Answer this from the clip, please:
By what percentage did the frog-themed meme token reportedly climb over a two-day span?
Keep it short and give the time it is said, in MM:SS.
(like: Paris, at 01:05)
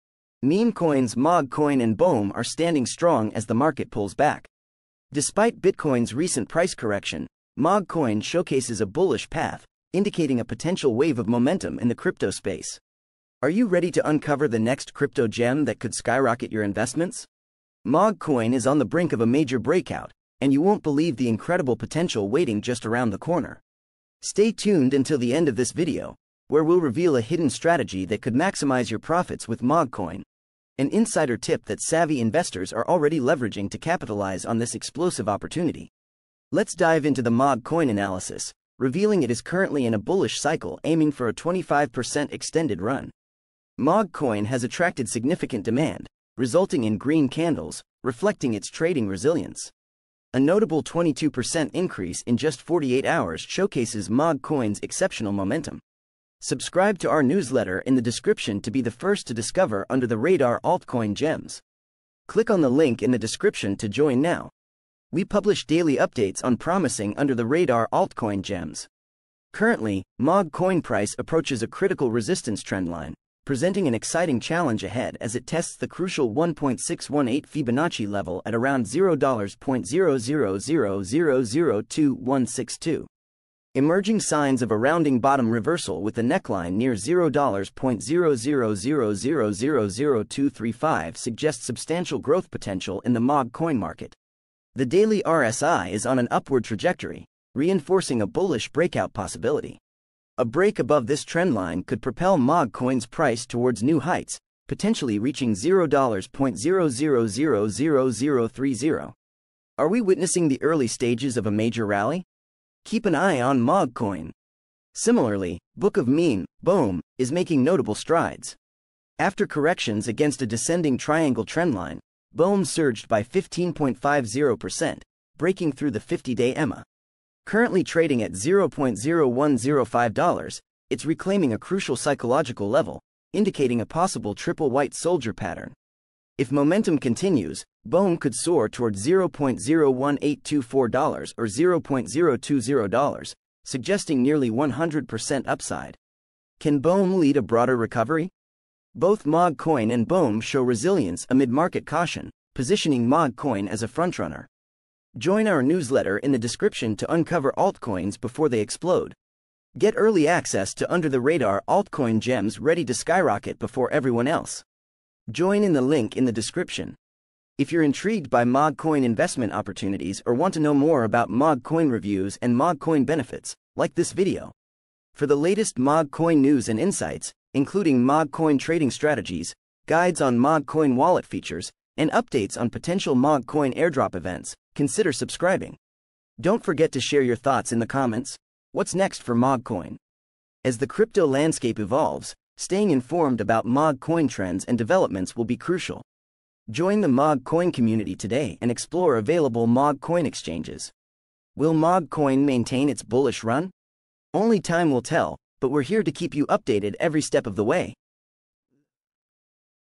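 22%, at 00:50.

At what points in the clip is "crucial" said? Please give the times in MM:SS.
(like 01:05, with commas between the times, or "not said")
01:15, 02:11, 03:15.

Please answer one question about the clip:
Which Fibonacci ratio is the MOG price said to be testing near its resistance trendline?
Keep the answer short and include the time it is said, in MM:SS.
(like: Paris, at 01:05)
1.618, at 01:16.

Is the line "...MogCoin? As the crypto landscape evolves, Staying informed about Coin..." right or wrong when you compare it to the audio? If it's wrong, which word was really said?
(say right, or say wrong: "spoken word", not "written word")
wrong: "MOG", not "Coin".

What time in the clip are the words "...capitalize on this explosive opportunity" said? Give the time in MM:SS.
00:33.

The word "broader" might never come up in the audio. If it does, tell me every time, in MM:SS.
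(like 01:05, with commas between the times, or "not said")
02:27.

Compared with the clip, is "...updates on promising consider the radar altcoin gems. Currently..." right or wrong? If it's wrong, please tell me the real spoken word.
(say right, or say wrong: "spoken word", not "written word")
wrong: "under", not "consider".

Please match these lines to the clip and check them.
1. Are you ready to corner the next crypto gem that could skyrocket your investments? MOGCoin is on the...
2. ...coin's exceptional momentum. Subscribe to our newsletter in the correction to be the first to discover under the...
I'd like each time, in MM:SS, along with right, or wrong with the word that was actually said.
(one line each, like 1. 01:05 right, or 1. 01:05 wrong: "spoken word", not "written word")
1. 00:13 wrong: "uncover", not "corner"
2. 00:54 wrong: "description", not "correction".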